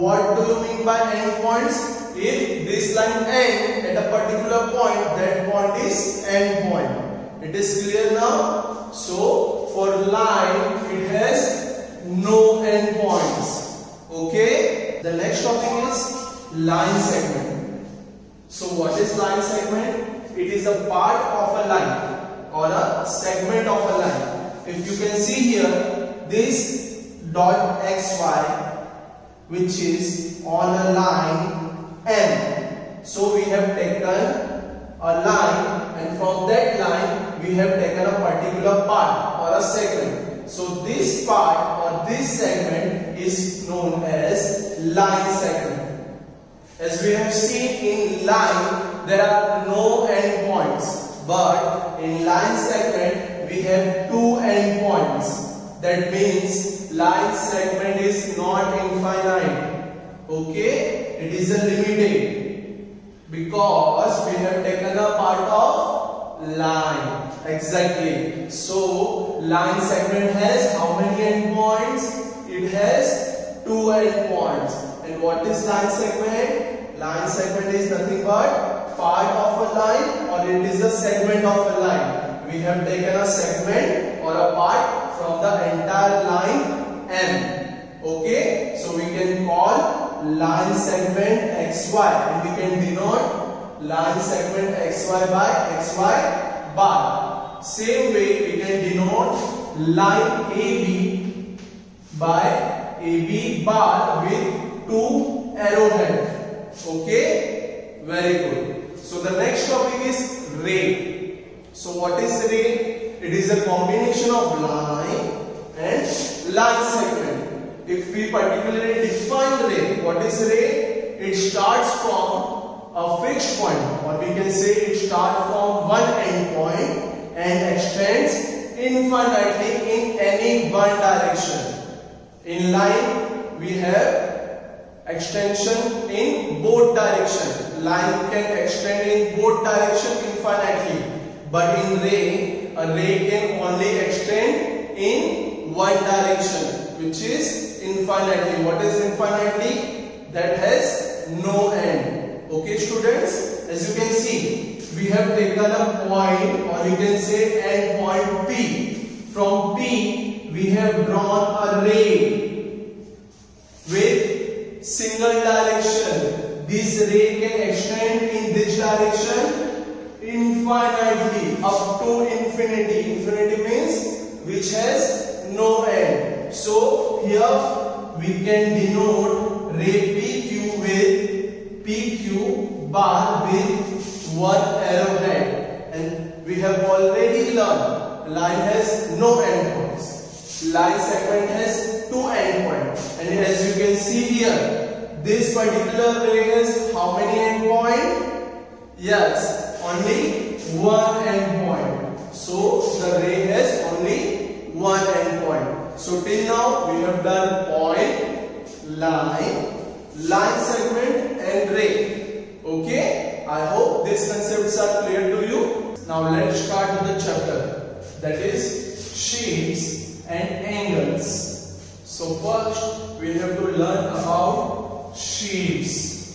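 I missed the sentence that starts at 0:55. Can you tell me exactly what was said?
That means line segment is not infinite.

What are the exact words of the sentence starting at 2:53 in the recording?
Infinity means which has no end.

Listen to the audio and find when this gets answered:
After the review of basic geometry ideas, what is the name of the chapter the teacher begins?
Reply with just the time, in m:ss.
3:39.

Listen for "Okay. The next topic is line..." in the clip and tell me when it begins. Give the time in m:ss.
0:14.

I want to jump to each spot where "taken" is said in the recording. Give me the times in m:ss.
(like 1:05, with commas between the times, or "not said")
0:33, 0:37, 1:04, 1:22, 2:35.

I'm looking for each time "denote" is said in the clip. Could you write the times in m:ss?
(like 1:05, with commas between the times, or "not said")
1:32, 1:38, 2:58.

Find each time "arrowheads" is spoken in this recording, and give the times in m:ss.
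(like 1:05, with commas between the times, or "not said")
1:45, 3:04.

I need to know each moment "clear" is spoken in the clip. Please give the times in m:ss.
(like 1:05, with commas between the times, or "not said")
0:07, 3:35.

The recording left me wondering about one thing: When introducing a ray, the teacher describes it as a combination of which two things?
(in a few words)
line and line segment.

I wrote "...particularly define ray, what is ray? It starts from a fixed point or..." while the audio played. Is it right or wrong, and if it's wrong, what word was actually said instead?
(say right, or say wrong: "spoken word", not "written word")
right.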